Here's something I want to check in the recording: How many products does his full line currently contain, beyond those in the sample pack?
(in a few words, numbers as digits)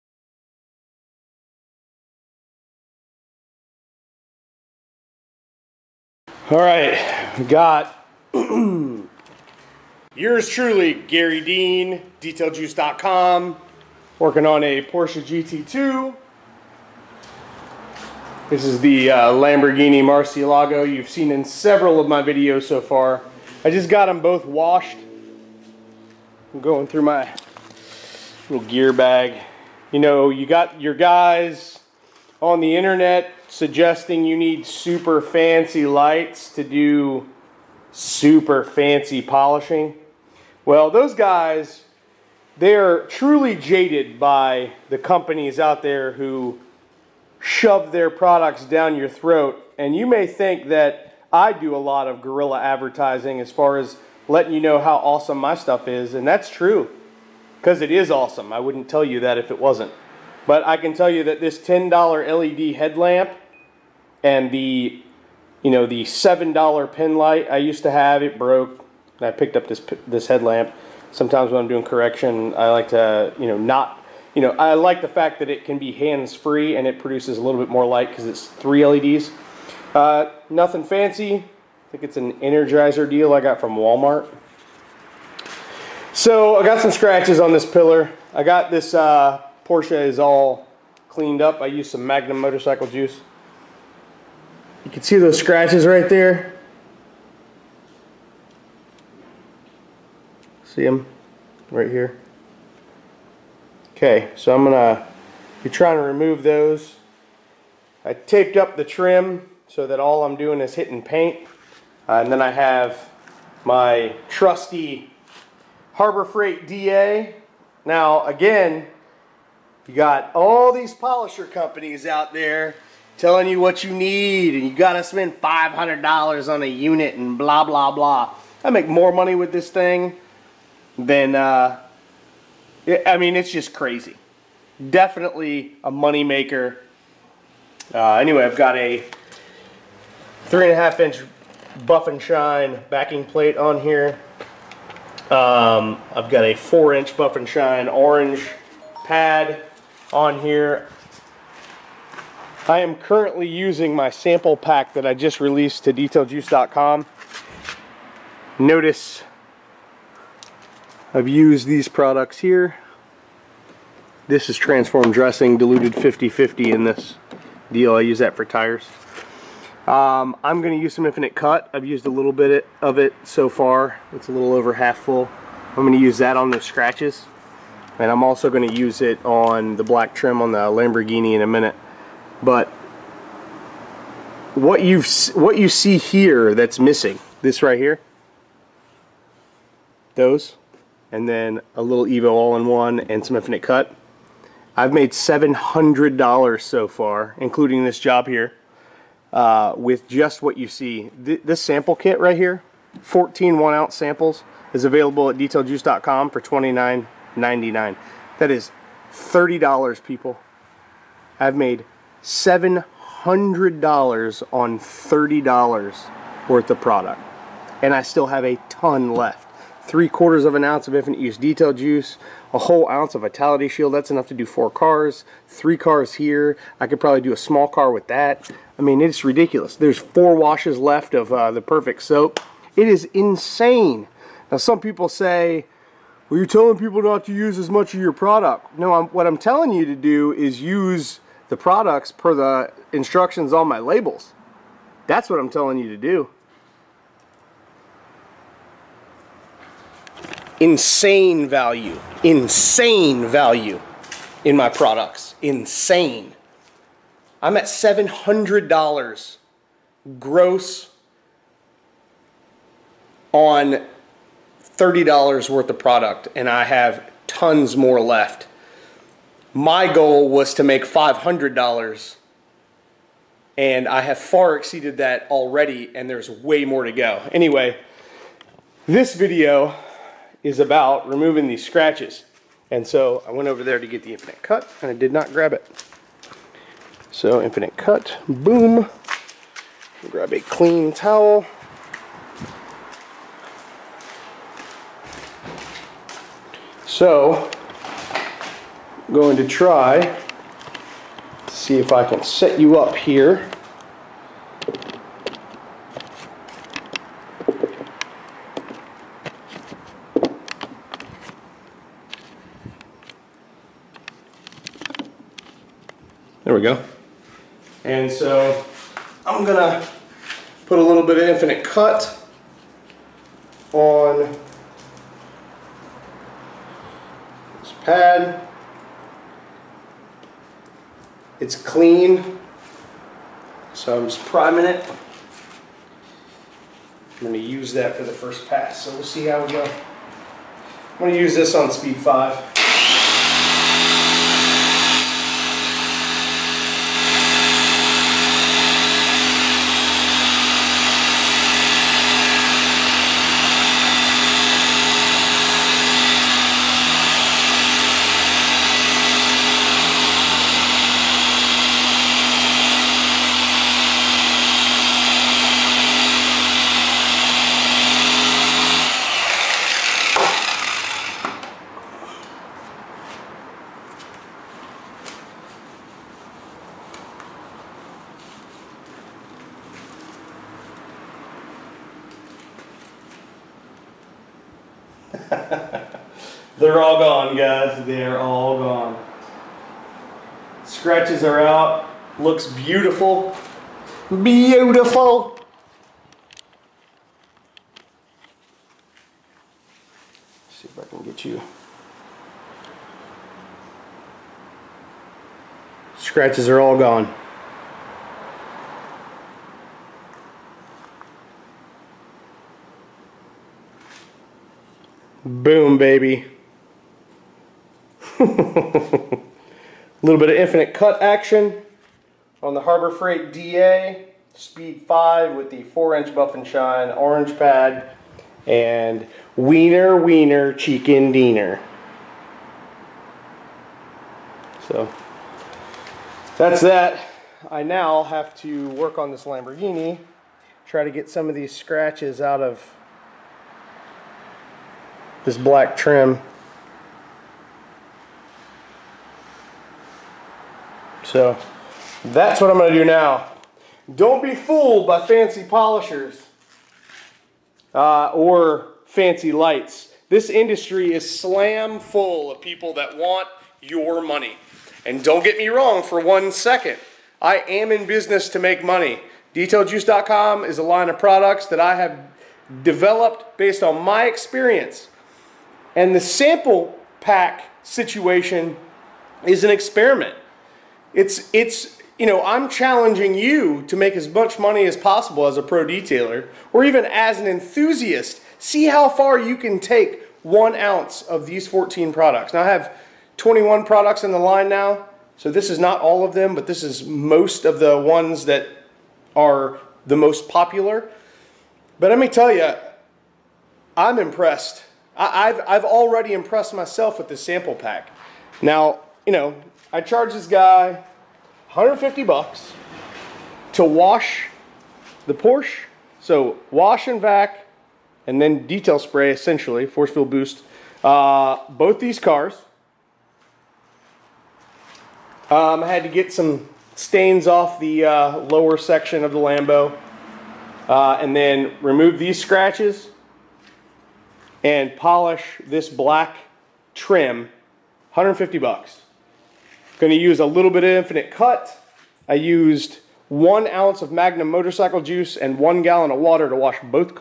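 21.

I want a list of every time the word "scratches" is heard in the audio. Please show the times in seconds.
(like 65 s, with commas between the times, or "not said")
86 s, 95 s, 176 s, 281 s, 390 s, 405 s, 441 s, 532 s.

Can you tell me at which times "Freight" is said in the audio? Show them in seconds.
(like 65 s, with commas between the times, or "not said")
116 s, 422 s.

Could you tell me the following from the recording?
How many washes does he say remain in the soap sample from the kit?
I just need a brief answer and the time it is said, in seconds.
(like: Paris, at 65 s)
4, at 229 s.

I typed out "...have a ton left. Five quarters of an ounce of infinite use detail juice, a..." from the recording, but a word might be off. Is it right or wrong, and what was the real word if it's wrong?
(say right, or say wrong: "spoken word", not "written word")
wrong: "Three", not "Five".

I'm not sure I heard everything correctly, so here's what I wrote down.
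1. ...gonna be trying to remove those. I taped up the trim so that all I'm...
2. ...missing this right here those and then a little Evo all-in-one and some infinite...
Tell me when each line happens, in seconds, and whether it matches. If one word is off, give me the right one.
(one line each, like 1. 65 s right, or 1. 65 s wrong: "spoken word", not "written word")
1. 104 s right
2. 186 s right.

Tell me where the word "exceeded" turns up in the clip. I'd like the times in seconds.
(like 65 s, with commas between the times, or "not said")
274 s.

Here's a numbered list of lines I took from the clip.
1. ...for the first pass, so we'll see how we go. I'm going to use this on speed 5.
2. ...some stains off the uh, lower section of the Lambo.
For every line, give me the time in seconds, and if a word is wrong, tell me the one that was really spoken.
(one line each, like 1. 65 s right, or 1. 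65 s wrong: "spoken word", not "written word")
1. 337 s right
2. 526 s right.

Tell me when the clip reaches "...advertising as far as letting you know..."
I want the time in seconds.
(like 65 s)
52 s.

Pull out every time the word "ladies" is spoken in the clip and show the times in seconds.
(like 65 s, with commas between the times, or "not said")
not said.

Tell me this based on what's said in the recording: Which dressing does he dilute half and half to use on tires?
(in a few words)
Transform.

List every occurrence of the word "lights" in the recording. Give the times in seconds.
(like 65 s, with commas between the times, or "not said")
35 s, 67 s, 77 s, 459 s.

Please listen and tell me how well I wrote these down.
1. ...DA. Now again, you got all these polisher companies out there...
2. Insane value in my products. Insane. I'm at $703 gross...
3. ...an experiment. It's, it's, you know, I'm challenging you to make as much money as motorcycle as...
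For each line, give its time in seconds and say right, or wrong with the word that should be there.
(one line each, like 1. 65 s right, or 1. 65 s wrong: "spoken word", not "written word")
1. 116 s right
2. 252 s wrong: "700", not "703"
3. 479 s wrong: "possible", not "motorcycle".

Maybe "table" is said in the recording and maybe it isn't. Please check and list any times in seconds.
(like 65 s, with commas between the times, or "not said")
not said.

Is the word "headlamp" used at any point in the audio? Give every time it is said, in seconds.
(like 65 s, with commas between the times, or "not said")
62 s, 70 s.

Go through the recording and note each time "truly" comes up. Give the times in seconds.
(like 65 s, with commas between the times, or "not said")
10 s, 43 s.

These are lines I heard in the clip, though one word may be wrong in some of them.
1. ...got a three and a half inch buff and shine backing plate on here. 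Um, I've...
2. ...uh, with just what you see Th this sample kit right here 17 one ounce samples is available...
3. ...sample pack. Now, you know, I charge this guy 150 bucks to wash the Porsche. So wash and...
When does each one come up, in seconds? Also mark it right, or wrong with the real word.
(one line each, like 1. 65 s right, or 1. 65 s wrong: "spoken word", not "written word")
1. 138 s right
2. 199 s wrong: "14", not "17"
3. 507 s right.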